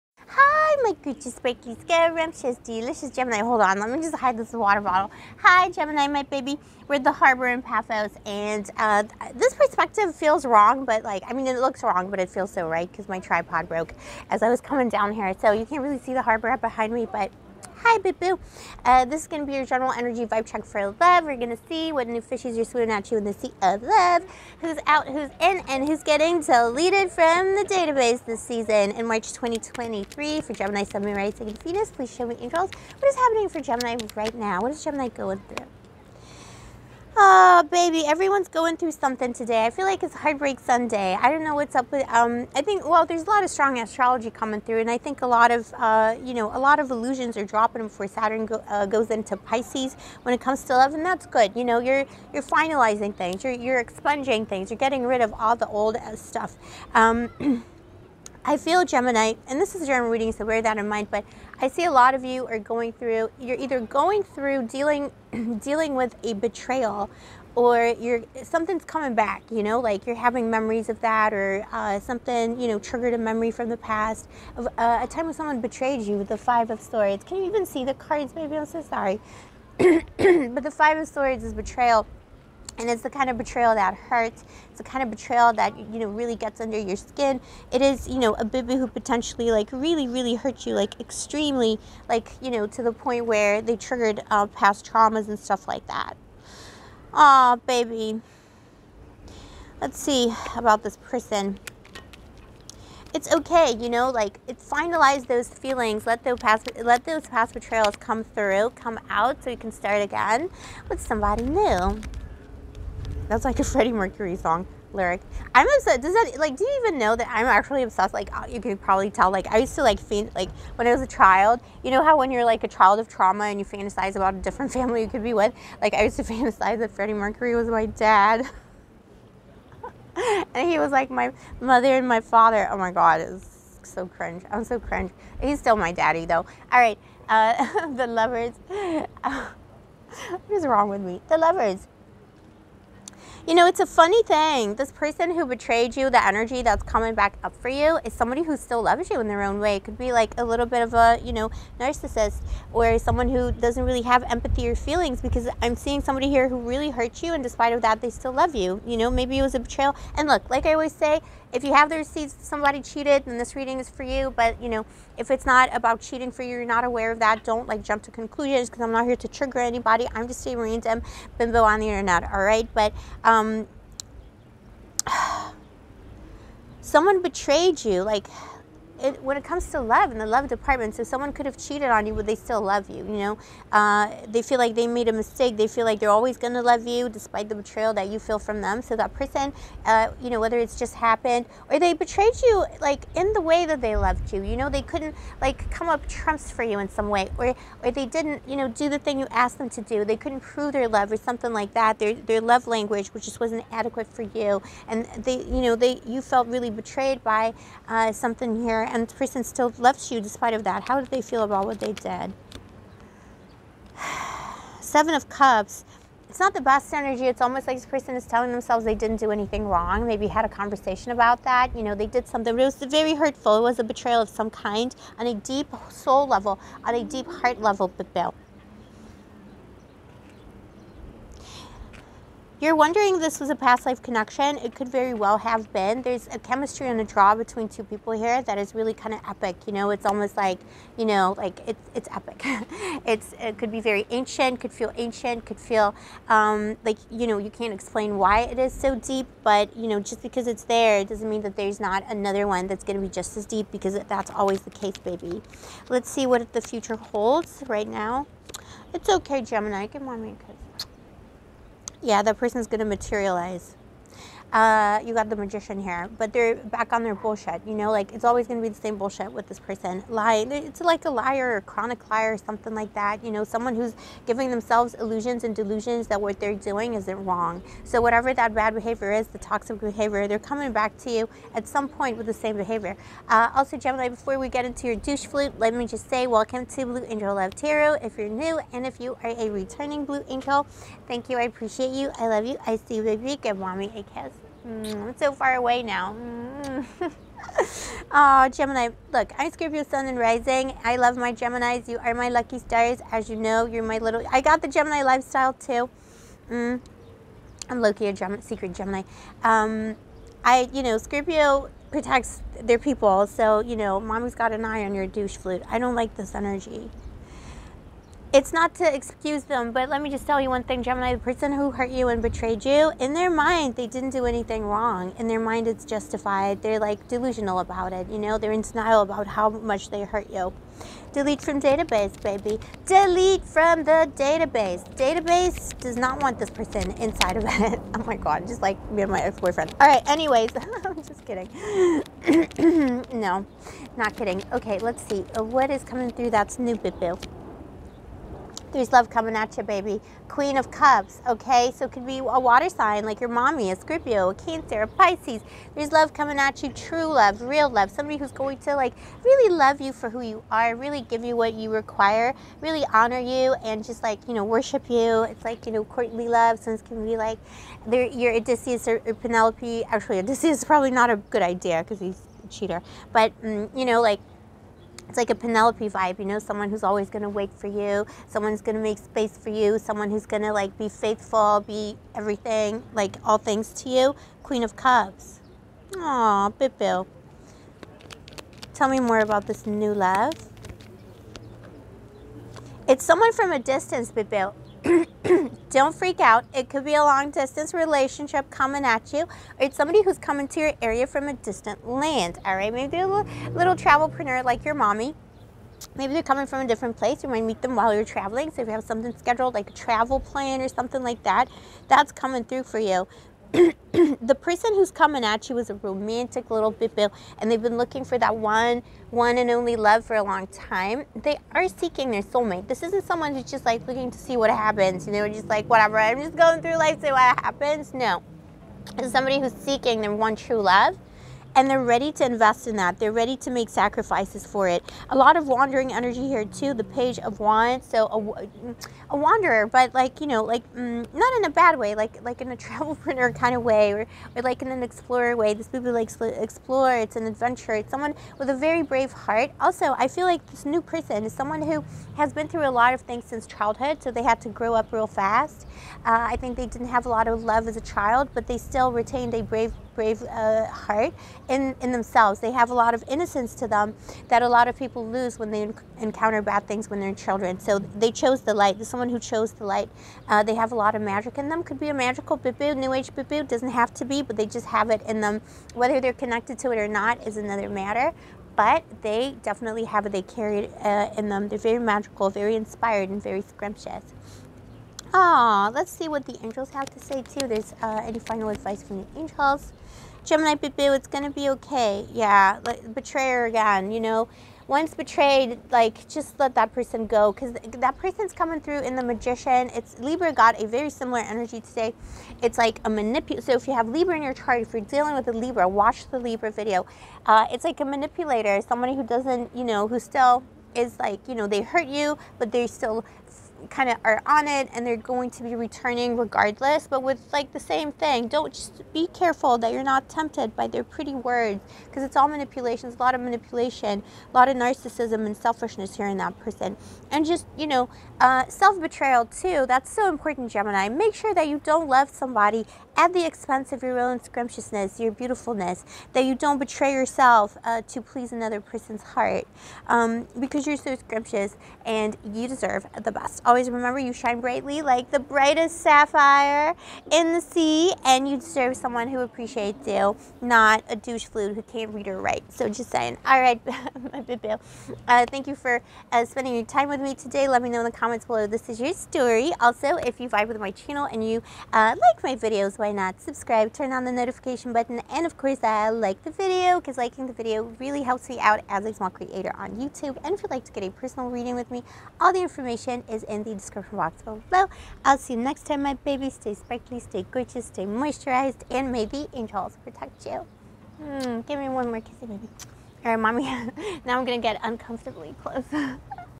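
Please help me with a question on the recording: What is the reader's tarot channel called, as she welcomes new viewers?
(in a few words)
Blue Angel Love Tarot.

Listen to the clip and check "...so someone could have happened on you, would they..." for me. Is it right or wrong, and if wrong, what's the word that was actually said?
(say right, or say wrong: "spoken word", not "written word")
wrong: "cheated", not "happened".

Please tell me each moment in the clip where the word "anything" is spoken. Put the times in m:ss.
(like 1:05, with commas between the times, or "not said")
3:39, 5:24.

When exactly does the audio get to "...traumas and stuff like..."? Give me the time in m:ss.
1:34.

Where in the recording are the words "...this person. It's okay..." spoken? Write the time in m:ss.
1:40.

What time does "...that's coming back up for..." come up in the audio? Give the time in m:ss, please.
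2:26.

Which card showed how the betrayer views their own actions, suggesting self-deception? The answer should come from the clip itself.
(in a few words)
Seven of Cups.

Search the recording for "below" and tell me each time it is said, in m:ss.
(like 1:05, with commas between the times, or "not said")
9:18, 9:34.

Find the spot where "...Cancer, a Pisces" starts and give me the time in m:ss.
5:54.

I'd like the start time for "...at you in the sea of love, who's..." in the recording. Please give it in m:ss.
0:22.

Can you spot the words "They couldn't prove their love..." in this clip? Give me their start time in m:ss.
3:20.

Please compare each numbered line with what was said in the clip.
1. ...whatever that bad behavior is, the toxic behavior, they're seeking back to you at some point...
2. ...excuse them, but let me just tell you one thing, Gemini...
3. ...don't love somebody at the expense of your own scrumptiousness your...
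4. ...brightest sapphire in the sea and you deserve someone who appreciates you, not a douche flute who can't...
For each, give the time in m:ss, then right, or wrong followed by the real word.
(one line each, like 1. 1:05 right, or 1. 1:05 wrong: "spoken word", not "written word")
1. 4:38 wrong: "coming", not "seeking"
2. 5:18 right
3. 8:51 right
4. 9:05 right.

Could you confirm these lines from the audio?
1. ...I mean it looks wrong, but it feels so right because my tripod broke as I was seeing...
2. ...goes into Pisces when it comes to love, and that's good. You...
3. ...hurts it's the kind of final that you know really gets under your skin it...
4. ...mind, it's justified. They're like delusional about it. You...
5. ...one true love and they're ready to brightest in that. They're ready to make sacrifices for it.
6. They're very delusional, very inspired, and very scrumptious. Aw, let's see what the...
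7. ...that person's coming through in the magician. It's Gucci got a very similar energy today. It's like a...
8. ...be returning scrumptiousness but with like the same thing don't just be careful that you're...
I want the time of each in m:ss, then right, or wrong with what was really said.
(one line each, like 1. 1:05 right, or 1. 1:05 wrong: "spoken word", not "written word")
1. 0:11 wrong: "coming", not "seeing"
2. 0:48 right
3. 1:23 wrong: "betrayal", not "final"
4. 5:25 right
5. 7:10 wrong: "invest", not "brightest"
6. 8:01 wrong: "magical", not "delusional"
7. 8:17 wrong: "Libra", not "Gucci"
8. 8:35 wrong: "regardless", not "scrumptiousness".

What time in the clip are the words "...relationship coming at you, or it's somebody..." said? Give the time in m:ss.
6:37.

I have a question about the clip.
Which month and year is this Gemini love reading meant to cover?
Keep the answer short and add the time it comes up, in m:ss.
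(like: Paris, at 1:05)
March 2023, at 0:29.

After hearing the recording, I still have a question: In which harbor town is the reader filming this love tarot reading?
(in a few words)
Paphos.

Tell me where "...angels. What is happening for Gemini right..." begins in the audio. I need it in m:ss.
0:32.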